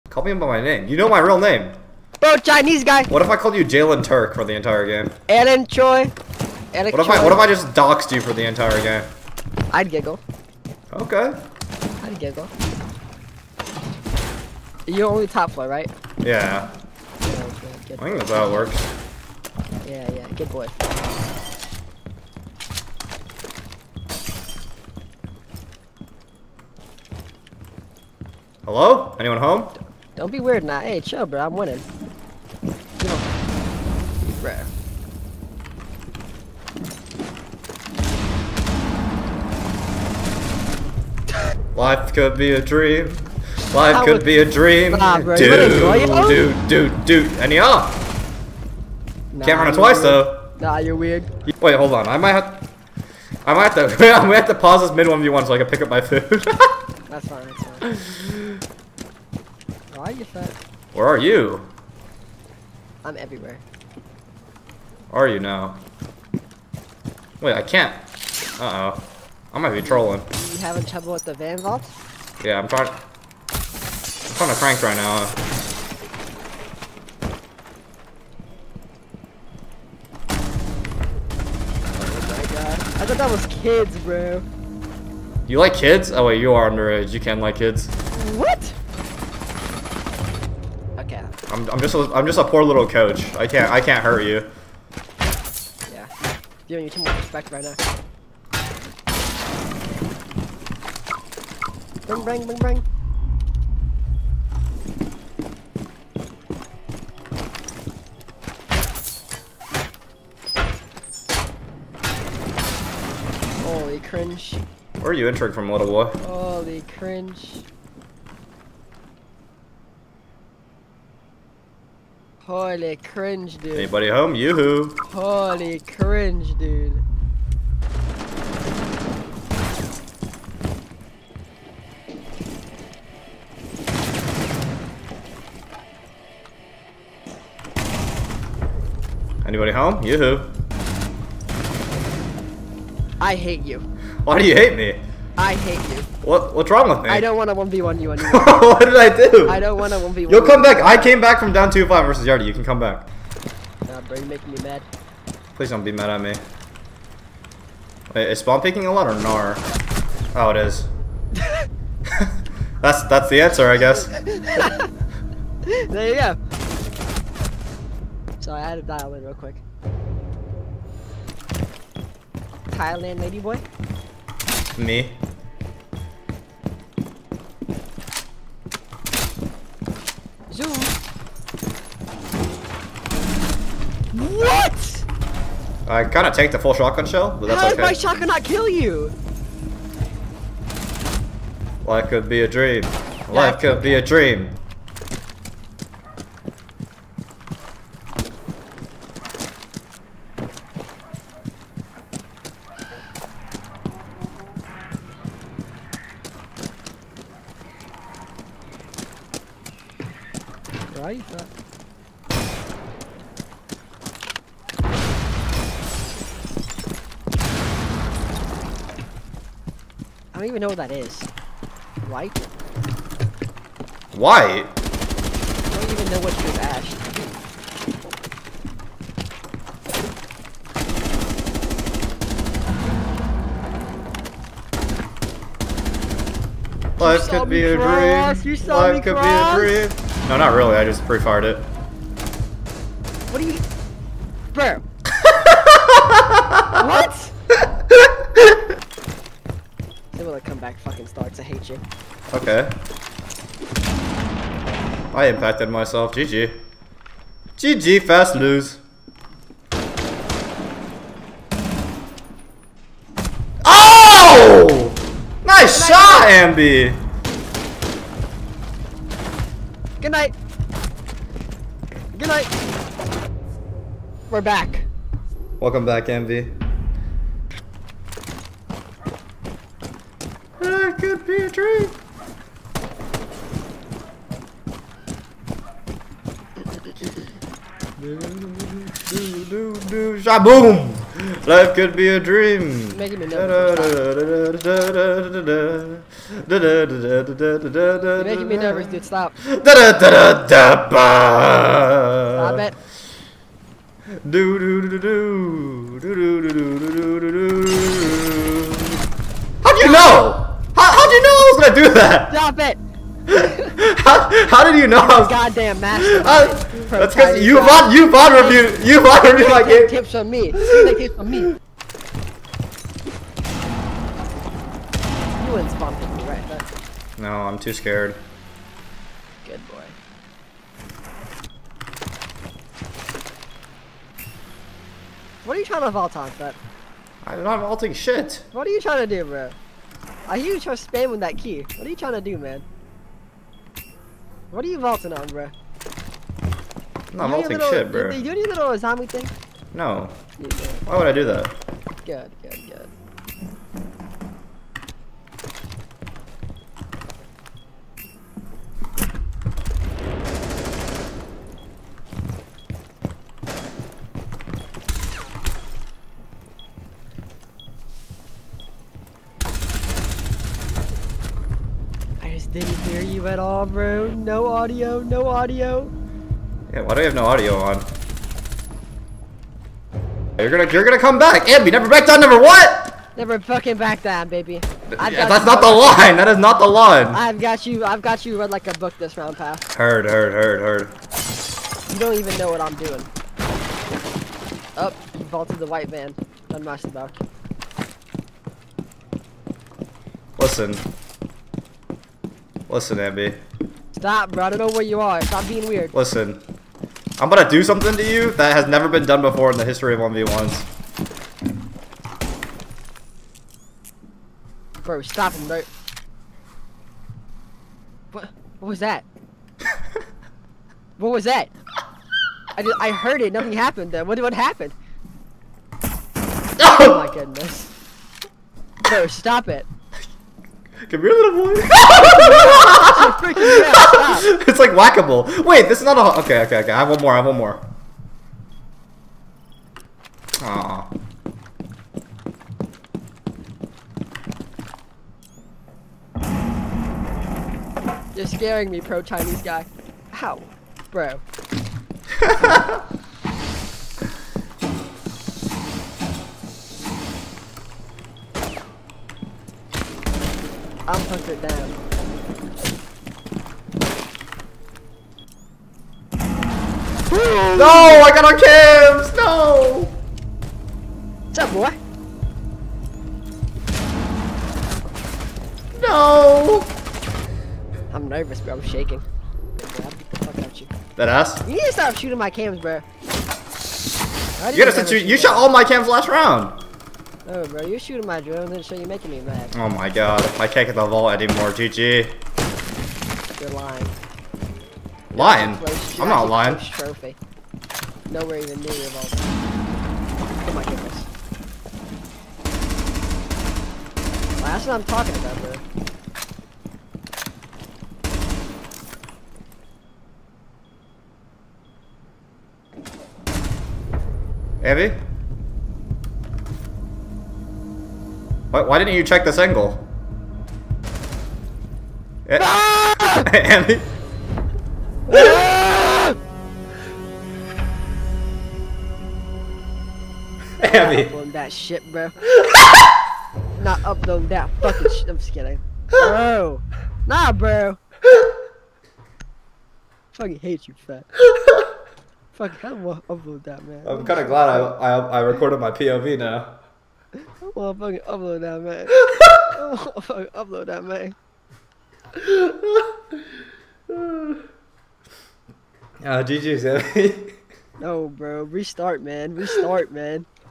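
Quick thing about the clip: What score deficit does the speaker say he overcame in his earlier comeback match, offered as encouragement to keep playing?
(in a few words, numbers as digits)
2-5.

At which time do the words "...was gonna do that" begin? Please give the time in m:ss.
5:11.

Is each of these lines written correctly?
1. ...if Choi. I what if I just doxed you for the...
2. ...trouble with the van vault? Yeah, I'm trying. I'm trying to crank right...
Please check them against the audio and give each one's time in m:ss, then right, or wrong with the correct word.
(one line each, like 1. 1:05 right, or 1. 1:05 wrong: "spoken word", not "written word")
1. 0:06 right
2. 1:10 right.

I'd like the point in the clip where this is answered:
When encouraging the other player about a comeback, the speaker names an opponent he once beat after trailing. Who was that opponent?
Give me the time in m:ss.
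2:32.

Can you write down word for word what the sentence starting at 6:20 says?
You're gonna, you're gonna come back.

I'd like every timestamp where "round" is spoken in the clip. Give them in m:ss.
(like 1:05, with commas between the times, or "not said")
6:29, 8:06.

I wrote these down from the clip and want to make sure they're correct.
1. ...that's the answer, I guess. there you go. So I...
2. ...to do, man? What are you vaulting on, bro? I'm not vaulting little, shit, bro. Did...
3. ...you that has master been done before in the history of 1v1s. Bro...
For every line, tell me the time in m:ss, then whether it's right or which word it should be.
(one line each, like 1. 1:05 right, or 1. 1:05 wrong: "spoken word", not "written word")
1. 2:43 right
2. 5:42 right
3. 6:48 wrong: "never", not "master".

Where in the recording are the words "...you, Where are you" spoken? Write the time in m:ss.
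1:00.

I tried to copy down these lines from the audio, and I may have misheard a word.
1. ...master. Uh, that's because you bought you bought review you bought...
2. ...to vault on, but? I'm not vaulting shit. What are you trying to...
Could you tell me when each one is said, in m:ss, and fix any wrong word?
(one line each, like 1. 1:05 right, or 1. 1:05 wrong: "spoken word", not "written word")
1. 5:15 right
2. 5:35 right.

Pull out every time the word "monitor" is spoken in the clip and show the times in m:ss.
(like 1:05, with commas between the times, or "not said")
not said.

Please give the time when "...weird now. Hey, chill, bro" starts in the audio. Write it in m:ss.
0:30.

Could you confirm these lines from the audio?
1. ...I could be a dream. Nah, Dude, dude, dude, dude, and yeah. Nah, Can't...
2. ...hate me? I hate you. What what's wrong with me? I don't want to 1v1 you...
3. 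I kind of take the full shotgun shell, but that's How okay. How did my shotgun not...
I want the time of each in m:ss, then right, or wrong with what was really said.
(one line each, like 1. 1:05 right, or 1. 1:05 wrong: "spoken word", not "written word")
1. 0:43 right
2. 2:24 right
3. 3:05 right.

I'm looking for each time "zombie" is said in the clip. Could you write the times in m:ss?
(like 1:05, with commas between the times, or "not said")
5:48.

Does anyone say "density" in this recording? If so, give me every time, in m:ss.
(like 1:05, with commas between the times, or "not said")
not said.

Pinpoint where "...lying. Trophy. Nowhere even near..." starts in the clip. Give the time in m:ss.
8:16.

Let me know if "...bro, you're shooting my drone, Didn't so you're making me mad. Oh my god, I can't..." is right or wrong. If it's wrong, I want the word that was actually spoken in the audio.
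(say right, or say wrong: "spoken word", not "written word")
right.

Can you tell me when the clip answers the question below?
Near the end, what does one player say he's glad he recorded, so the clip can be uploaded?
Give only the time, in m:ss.
9:05.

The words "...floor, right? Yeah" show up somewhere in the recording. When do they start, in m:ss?
0:15.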